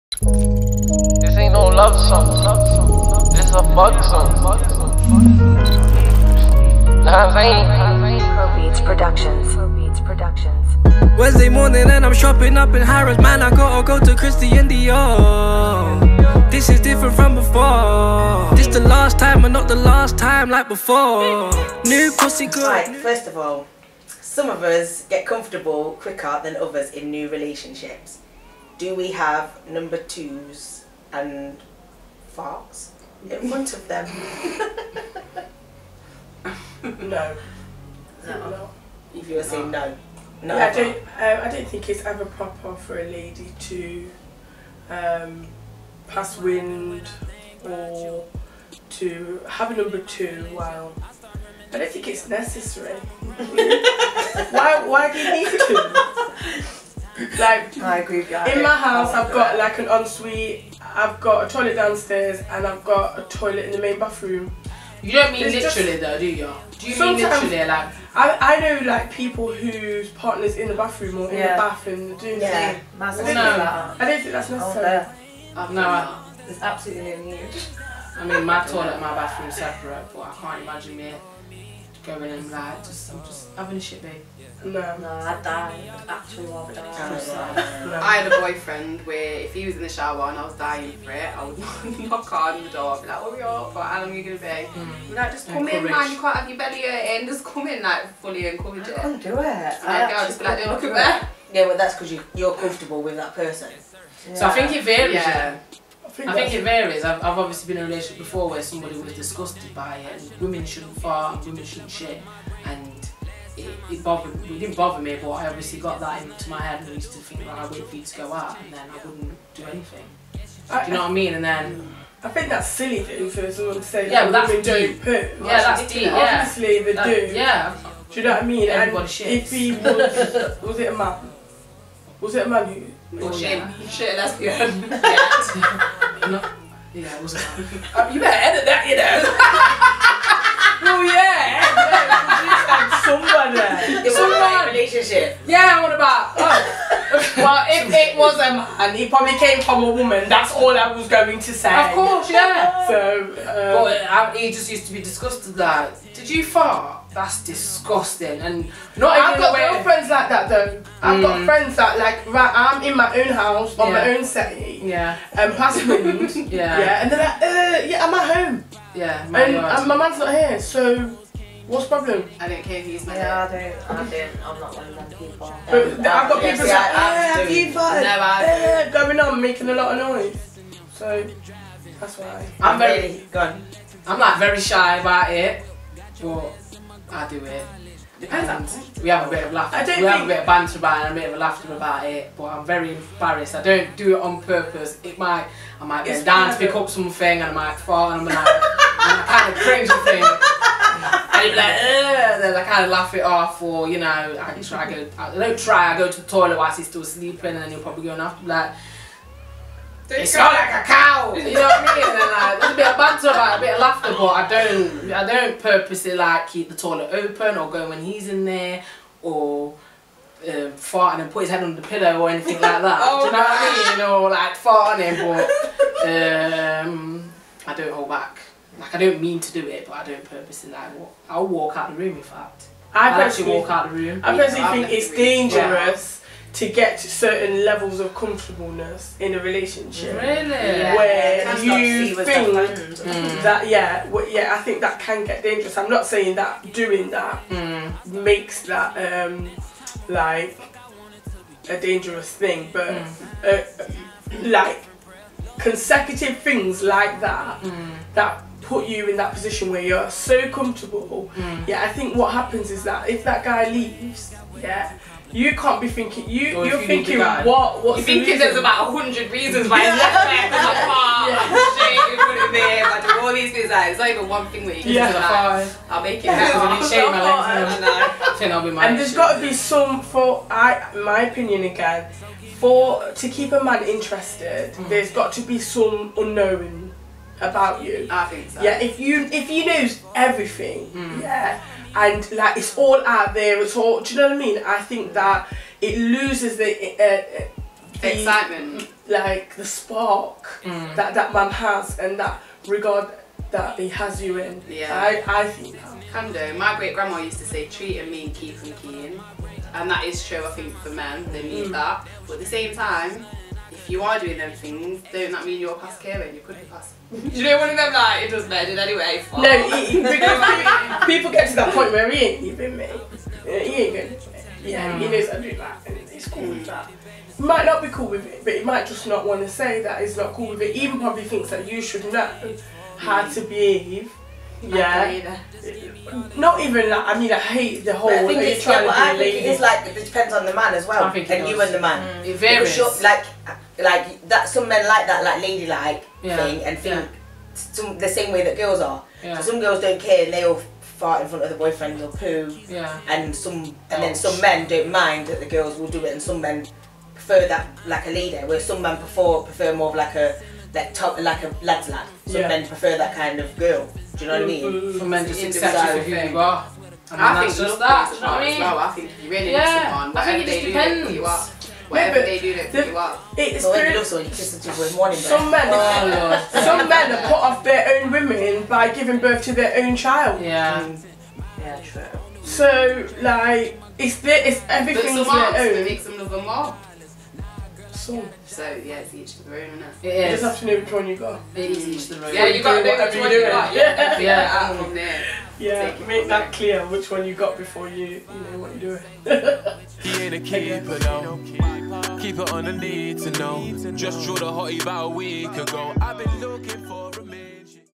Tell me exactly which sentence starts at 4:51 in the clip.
yeah and like it's all out there it's all do you know what i mean i think mm.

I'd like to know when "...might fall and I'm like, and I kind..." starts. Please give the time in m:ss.
3:17.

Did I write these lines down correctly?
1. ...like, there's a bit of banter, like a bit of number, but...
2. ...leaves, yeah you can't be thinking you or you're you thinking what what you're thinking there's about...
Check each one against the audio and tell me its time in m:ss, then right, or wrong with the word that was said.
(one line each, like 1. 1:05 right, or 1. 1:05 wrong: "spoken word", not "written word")
1. 3:32 wrong: "laughter", not "number"
2. 4:23 right.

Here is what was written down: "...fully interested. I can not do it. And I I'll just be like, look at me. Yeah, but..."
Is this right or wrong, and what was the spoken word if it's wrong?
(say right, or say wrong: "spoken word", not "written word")
wrong: "encouraged", not "interested".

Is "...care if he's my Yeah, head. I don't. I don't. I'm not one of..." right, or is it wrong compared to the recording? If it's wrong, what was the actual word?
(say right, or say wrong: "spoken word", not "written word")
right.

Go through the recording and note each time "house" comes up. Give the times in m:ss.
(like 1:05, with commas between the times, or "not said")
0:58, 2:43.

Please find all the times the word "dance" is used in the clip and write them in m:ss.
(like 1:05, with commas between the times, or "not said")
3:16.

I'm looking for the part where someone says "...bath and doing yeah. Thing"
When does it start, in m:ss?
1:11.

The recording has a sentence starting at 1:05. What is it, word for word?
You don't mean literally just, though, do you?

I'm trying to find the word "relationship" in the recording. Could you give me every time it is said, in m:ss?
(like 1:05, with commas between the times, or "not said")
0:27, 1:47, 2:24, 3:59.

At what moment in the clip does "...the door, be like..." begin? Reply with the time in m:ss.
1:32.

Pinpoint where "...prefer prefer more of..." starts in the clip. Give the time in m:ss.
5:58.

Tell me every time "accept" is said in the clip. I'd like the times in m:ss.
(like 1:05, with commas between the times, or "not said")
6:05.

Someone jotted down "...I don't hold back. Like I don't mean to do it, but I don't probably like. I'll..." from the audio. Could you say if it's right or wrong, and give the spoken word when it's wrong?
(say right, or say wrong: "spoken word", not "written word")
wrong: "purposely", not "probably".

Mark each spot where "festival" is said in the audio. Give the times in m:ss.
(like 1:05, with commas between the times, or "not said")
not said.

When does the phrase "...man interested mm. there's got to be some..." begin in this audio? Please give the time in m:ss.
4:43.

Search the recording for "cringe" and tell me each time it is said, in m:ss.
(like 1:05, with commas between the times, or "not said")
3:19.